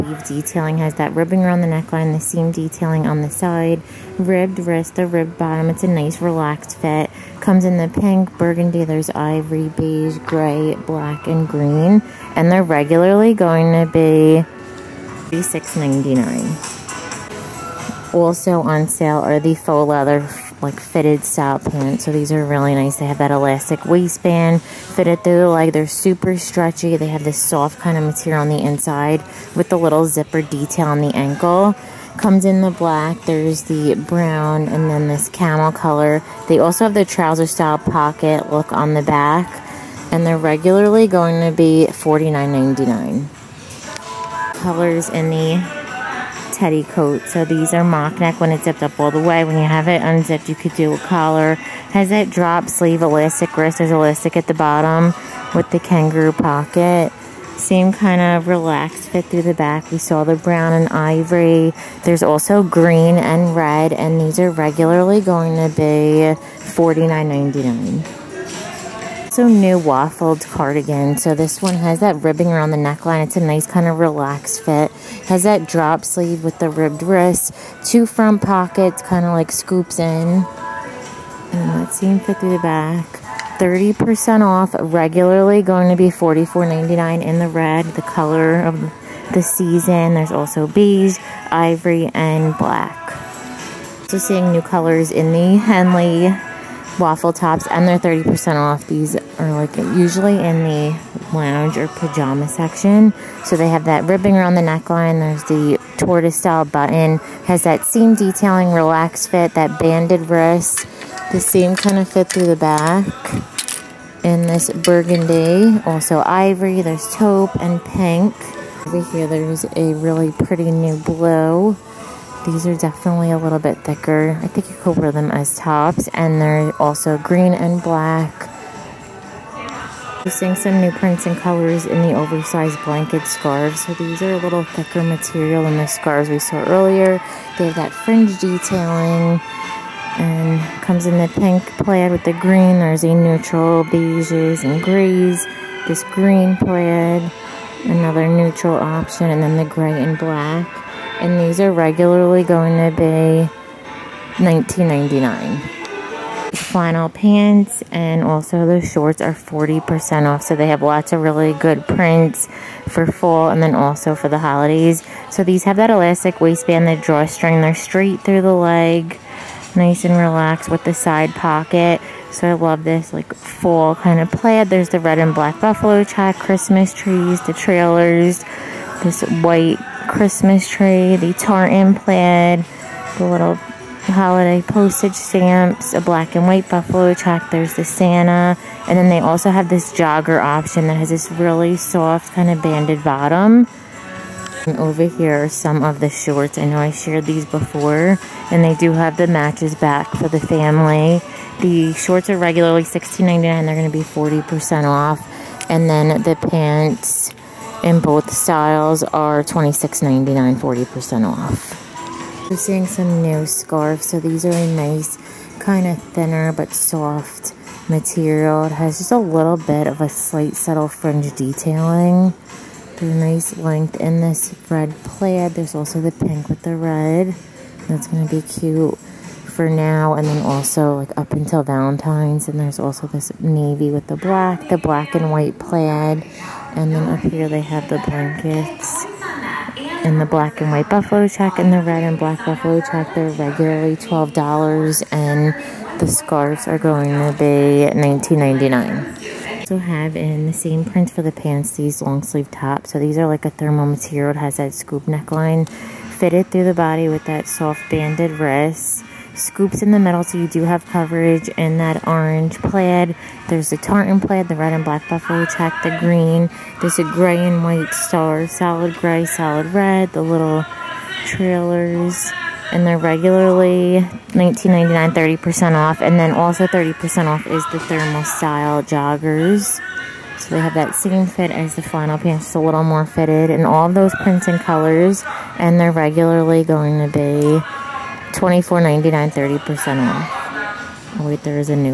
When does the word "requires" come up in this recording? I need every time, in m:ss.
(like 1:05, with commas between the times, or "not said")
not said.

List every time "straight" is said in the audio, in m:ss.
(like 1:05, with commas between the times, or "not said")
2:47.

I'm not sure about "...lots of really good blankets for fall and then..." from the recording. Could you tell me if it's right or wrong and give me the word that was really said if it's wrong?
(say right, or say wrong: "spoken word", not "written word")
wrong: "prints", not "blankets".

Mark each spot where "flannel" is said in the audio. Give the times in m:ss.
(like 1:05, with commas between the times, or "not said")
2:36, 4:41.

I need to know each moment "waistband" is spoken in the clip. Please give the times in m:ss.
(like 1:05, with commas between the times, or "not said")
0:23, 2:46.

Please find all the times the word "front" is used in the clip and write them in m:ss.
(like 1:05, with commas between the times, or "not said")
1:18.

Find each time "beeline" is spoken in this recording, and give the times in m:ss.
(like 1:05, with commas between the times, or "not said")
not said.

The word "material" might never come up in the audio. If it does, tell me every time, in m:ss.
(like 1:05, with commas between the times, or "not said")
0:28, 2:15, 3:37, 4:13.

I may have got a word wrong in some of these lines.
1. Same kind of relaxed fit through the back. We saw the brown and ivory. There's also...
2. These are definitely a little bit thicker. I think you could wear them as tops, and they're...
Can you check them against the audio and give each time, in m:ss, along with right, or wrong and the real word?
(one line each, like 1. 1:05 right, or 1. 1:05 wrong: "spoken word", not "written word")
1. 0:57 right
2. 2:02 right.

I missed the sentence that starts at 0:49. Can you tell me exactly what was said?
When you have it unzipped, you could do a collar.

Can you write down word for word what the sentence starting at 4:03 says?
They're regularly $12 and the scarves are going to be $19.99.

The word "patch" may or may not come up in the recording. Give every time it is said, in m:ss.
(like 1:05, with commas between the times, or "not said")
not said.